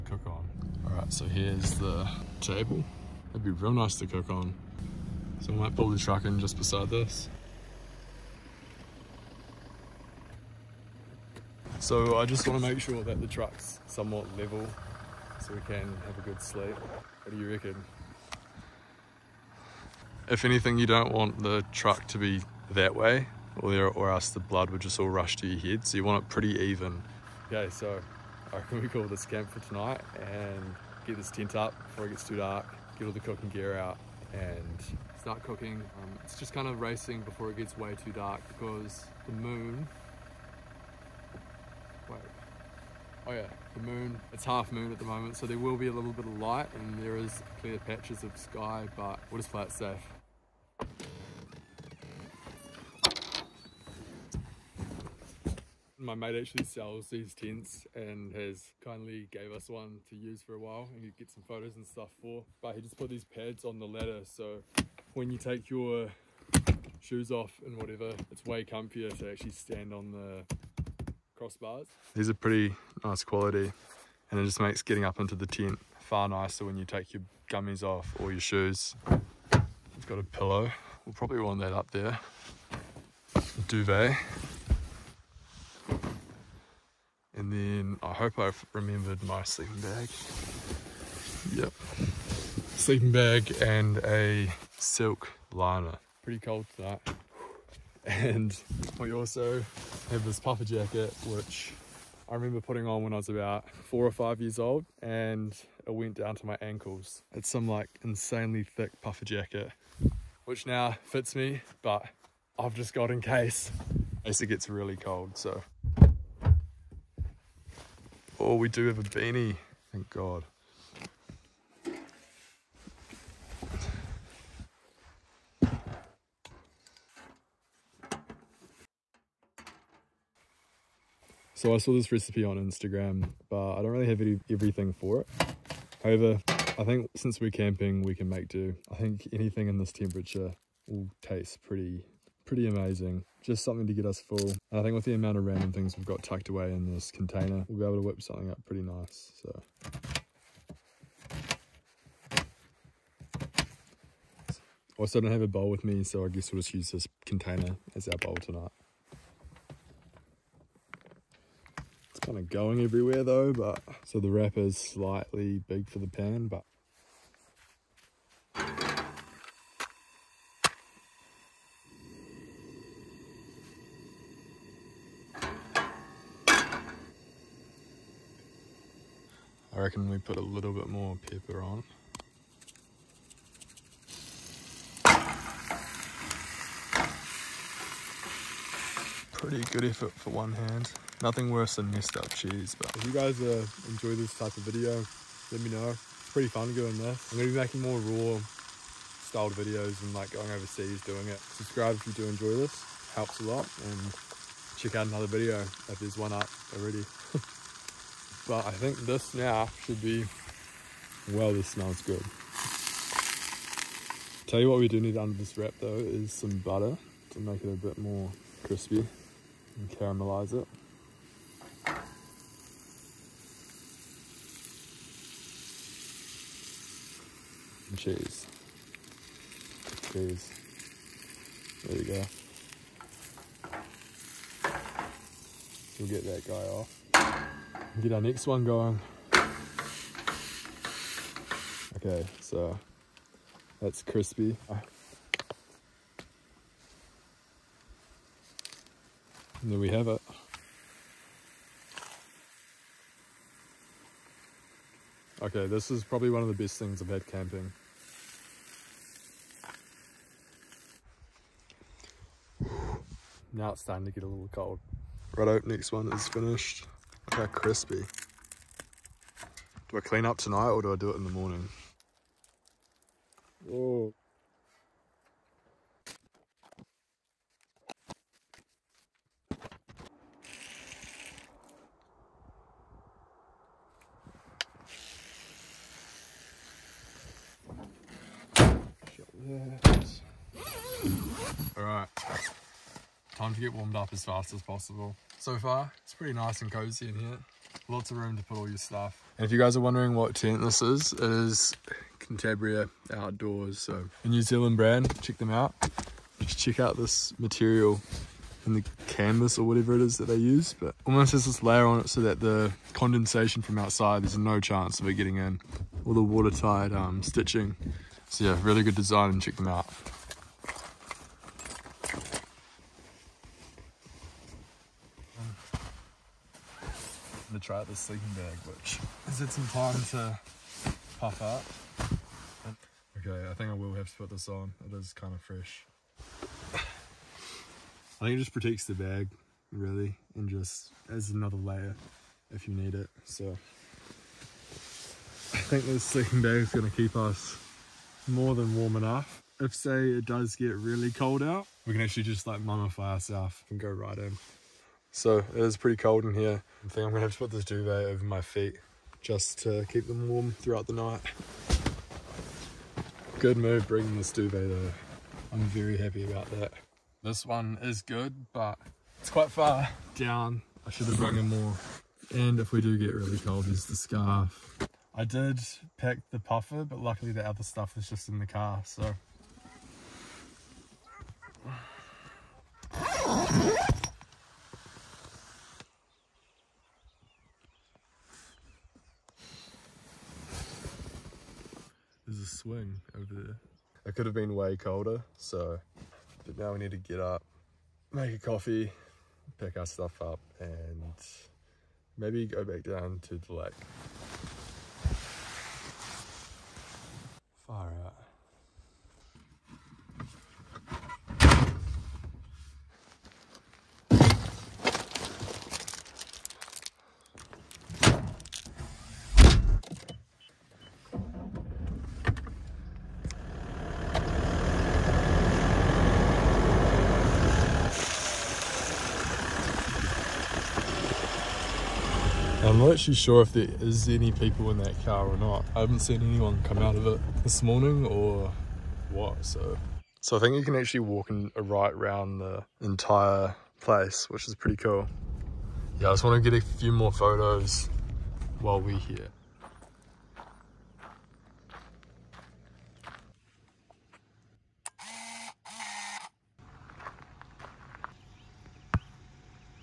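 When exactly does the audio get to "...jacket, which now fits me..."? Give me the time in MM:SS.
01:49.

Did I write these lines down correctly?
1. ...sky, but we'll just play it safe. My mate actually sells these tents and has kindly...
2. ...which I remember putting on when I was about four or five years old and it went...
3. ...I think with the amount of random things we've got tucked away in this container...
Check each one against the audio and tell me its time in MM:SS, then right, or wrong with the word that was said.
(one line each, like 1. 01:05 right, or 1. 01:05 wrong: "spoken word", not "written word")
1. 00:48 right
2. 01:41 right
3. 02:24 right.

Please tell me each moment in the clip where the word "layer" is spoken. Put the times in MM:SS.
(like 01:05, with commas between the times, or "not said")
05:11, 05:41.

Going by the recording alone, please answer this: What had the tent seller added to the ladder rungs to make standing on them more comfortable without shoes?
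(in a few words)
Pads.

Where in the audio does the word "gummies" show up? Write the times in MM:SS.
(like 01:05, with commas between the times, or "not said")
01:17.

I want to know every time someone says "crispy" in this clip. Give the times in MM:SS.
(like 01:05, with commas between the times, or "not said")
03:38, 04:04, 04:27.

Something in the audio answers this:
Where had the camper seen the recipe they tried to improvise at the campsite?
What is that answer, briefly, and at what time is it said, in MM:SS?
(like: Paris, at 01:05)
Instagram, at 02:12.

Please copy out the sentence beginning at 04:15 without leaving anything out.
Okay, this is probably one of the best things I've had camping.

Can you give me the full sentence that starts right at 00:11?
So I just want to make sure that the truck's somewhat level so we can have a good sleep.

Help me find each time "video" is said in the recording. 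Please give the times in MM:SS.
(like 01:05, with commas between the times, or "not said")
03:14, 03:19, 03:25.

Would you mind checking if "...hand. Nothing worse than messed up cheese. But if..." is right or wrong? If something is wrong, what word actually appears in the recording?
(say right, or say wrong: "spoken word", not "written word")
right.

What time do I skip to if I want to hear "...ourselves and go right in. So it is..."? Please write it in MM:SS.
05:53.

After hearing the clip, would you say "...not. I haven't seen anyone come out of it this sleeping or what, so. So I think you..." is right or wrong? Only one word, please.
wrong.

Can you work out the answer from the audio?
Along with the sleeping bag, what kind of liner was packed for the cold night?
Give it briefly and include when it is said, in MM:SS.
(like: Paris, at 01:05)
Silk liner, at 01:34.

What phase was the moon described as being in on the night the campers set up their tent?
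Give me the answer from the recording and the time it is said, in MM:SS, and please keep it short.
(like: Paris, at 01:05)
Half moon, at 00:44.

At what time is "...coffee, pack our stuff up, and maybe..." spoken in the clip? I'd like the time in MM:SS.
06:38.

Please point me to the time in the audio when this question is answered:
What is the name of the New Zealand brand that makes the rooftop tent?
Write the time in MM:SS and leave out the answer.
05:02.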